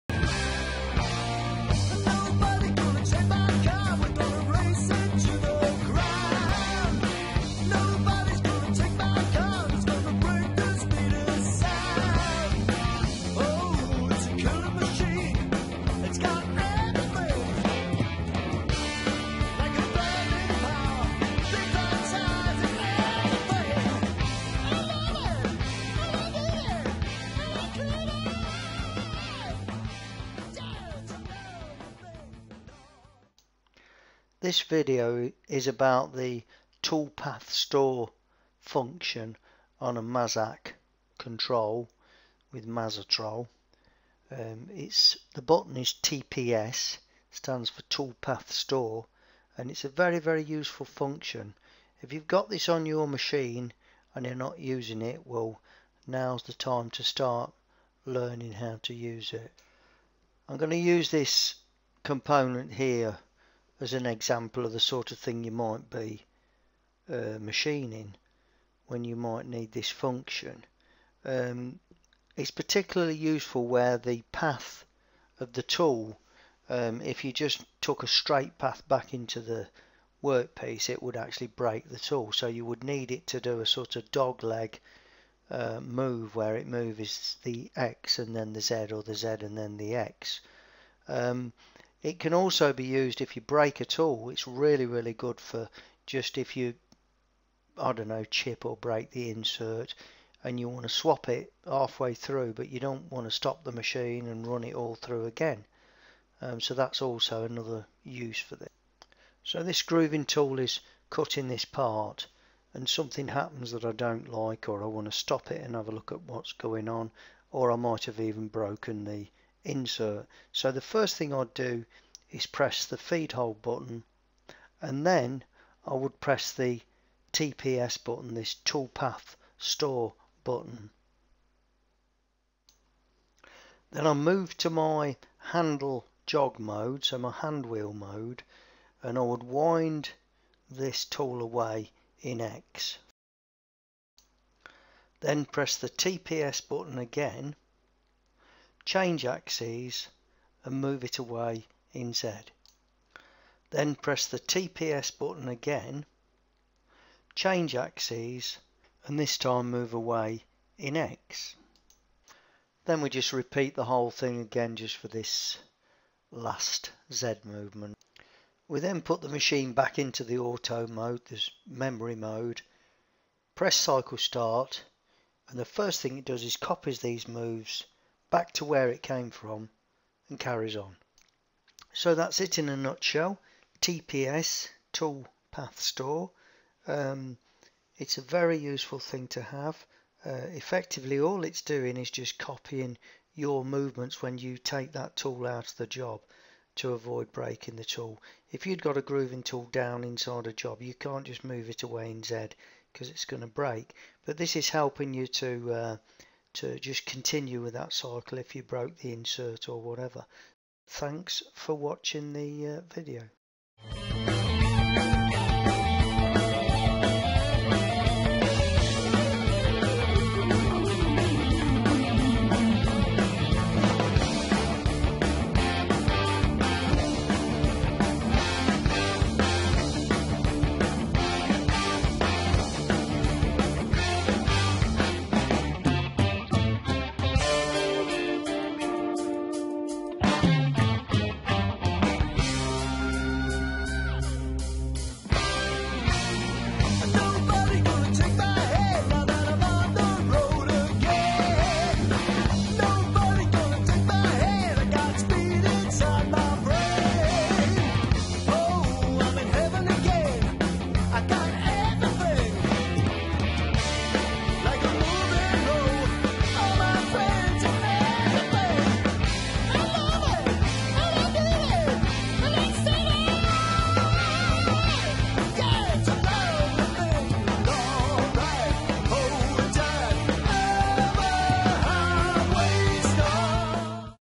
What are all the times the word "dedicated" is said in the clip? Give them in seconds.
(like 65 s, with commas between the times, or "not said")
not said.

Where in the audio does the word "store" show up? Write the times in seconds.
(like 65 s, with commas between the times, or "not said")
37 s, 48 s, 129 s, 185 s.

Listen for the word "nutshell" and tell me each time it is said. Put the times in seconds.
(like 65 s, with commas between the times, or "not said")
182 s.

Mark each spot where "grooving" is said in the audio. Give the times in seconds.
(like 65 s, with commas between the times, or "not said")
109 s, 199 s.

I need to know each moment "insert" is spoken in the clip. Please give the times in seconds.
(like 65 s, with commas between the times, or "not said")
99 s, 119 s, 209 s.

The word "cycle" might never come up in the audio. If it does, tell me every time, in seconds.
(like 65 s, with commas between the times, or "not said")
173 s, 207 s.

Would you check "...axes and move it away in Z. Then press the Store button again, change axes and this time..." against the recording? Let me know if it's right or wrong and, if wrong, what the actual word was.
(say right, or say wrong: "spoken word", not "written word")
wrong: "TPS", not "Store".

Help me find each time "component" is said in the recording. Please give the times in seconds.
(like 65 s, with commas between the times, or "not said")
62 s.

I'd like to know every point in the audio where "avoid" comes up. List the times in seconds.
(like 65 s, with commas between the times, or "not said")
196 s.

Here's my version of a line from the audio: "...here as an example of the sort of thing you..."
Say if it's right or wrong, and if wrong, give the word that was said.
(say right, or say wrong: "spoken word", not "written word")
right.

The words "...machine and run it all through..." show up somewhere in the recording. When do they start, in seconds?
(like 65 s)
103 s.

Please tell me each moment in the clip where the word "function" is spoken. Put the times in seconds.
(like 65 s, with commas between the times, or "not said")
38 s, 50 s, 69 s.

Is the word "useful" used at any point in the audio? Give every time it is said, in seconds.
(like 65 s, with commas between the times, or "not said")
50 s, 73 s, 188 s.